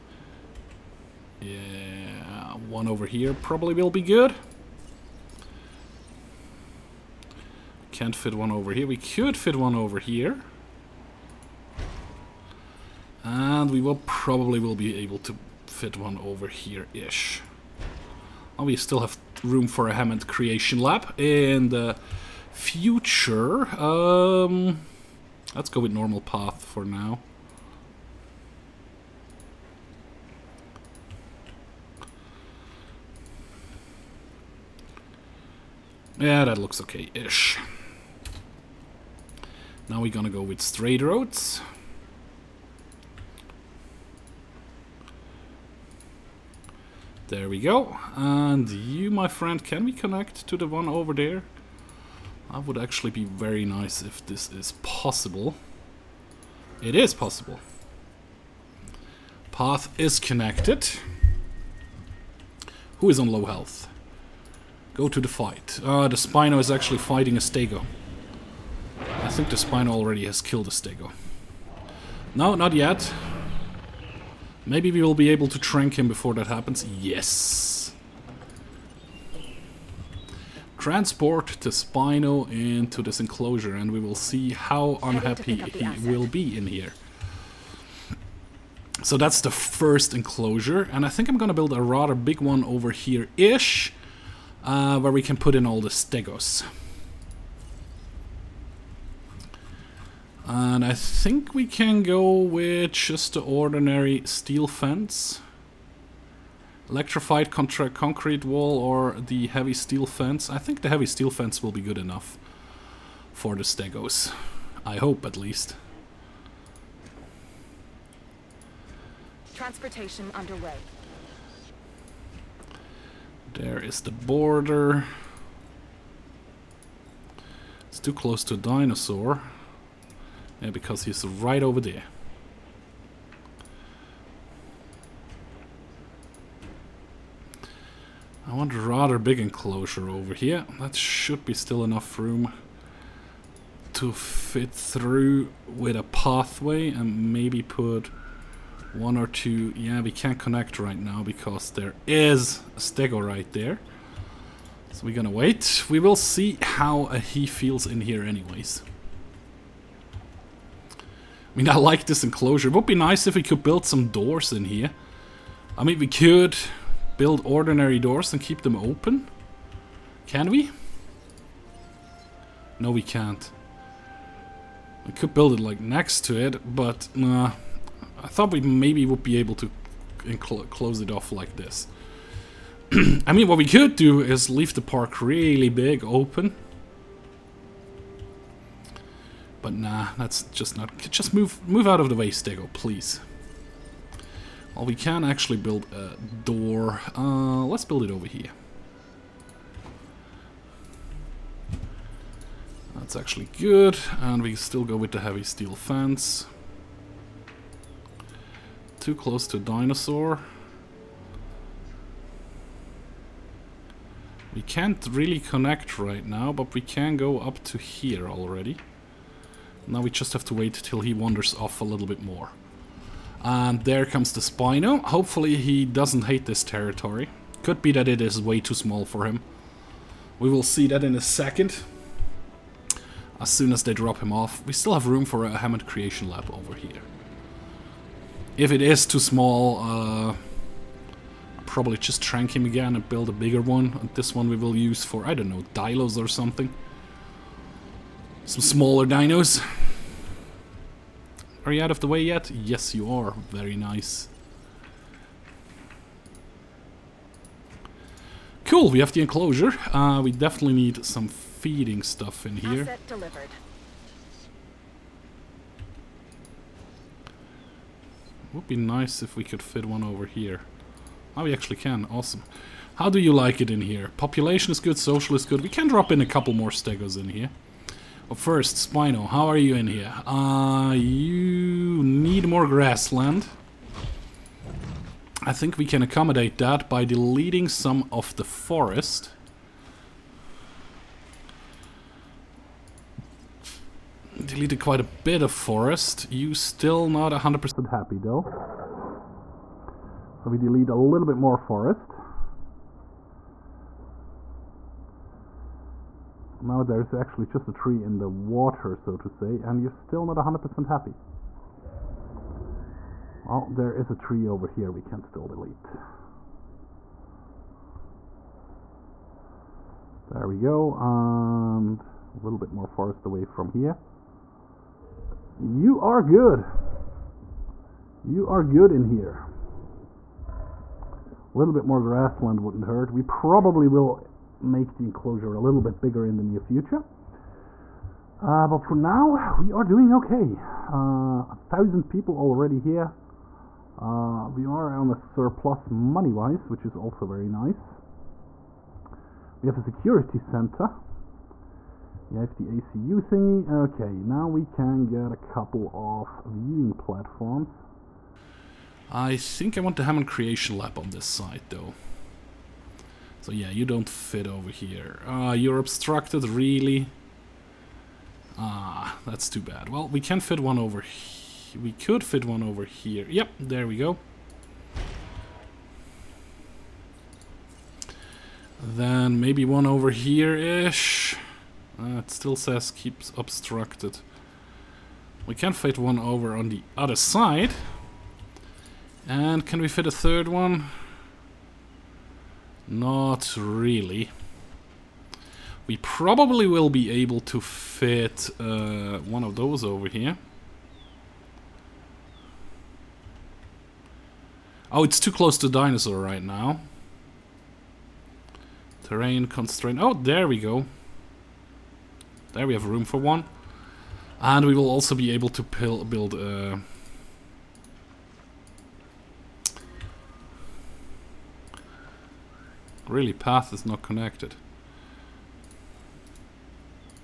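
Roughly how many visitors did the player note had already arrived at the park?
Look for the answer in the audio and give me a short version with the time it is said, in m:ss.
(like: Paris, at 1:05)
1000, at 5:41.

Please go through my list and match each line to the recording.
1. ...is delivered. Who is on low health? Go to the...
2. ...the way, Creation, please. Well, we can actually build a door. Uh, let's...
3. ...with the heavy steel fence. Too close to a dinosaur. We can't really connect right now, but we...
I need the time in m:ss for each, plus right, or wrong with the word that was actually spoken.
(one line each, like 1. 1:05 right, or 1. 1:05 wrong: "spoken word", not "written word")
1. 0:59 wrong: "connected", not "delivered"
2. 3:12 wrong: "Stego", not "Creation"
3. 3:24 right.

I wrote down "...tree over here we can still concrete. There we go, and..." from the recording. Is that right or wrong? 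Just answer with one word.
wrong.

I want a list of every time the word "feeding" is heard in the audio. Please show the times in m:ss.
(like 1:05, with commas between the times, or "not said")
4:21.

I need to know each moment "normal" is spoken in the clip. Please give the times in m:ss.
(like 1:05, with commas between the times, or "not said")
0:25.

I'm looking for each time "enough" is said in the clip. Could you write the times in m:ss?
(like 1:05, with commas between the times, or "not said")
1:51, 2:21.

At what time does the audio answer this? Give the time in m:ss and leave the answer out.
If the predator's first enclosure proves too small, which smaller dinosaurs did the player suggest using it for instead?
4:05.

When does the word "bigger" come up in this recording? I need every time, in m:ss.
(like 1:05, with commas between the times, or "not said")
4:03, 5:35.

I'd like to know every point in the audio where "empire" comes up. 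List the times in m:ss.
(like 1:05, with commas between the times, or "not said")
not said.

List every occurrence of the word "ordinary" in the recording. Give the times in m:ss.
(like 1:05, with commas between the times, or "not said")
1:43, 2:47.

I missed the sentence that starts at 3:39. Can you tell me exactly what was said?
Now we just have to wait till he wanders off a little bit more.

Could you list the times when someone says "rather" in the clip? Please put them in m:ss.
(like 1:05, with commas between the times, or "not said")
1:31, 2:18.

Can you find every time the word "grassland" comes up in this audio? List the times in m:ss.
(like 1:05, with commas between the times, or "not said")
4:42, 5:32.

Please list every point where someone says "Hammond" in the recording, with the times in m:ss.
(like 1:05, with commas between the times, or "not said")
0:19, 3:55, 6:00.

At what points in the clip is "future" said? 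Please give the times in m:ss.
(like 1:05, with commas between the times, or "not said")
0:22, 5:36.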